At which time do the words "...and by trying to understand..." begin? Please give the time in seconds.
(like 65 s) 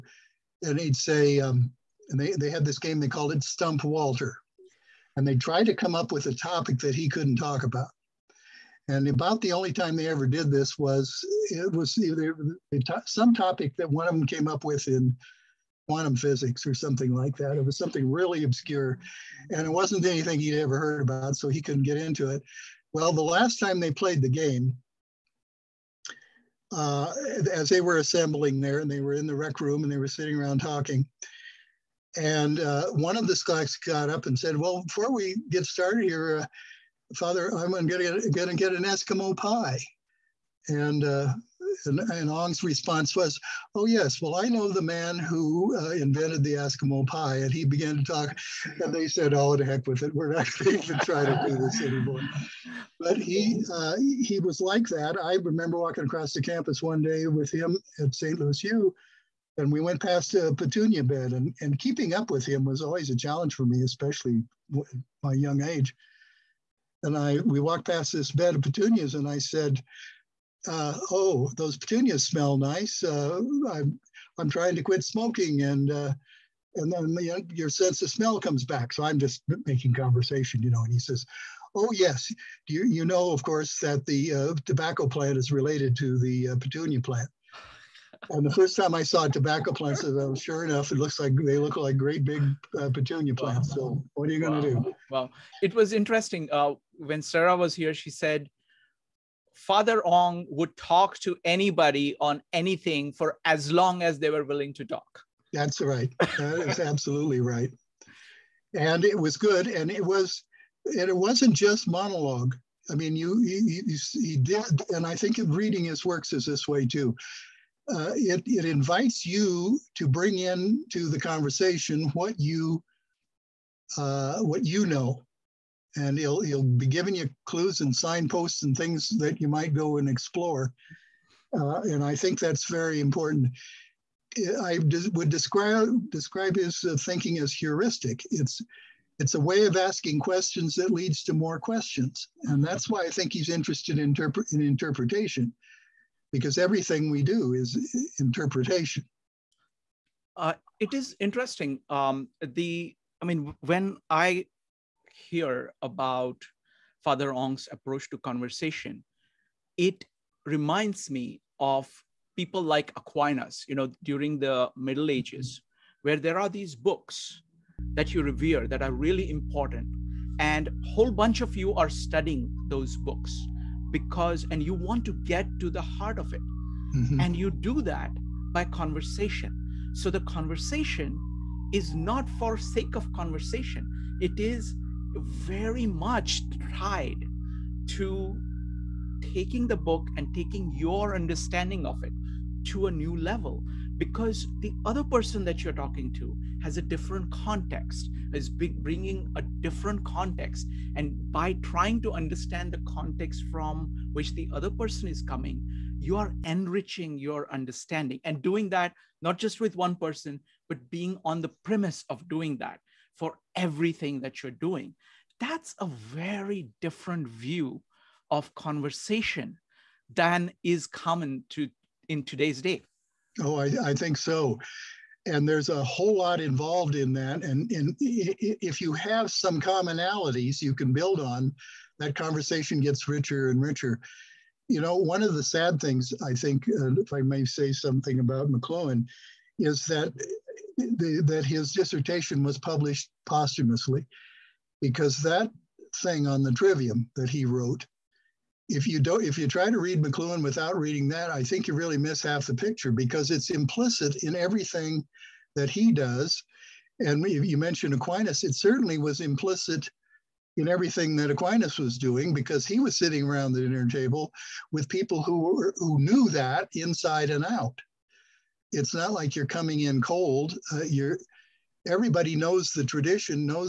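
200 s.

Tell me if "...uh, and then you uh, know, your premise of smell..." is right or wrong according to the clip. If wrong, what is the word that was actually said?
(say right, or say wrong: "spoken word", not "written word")
wrong: "sense", not "premise".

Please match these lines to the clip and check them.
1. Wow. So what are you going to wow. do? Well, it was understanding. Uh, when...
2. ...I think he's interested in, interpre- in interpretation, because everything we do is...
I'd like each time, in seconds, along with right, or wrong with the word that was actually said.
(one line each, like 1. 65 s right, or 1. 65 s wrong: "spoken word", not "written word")
1. 93 s wrong: "interesting", not "understanding"
2. 143 s right.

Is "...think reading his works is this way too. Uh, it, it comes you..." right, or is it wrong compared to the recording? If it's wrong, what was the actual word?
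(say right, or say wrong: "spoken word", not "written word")
wrong: "invites", not "comes".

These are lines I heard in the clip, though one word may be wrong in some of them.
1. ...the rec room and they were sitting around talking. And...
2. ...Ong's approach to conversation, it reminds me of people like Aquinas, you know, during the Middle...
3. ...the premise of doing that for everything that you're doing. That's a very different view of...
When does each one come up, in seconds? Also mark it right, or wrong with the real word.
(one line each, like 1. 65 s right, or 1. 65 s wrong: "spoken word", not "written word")
1. 29 s right
2. 157 s right
3. 211 s right.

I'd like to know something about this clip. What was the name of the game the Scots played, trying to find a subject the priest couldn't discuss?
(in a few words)
Stump Walter.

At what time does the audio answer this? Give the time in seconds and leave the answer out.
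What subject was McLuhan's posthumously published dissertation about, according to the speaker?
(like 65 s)
246 s.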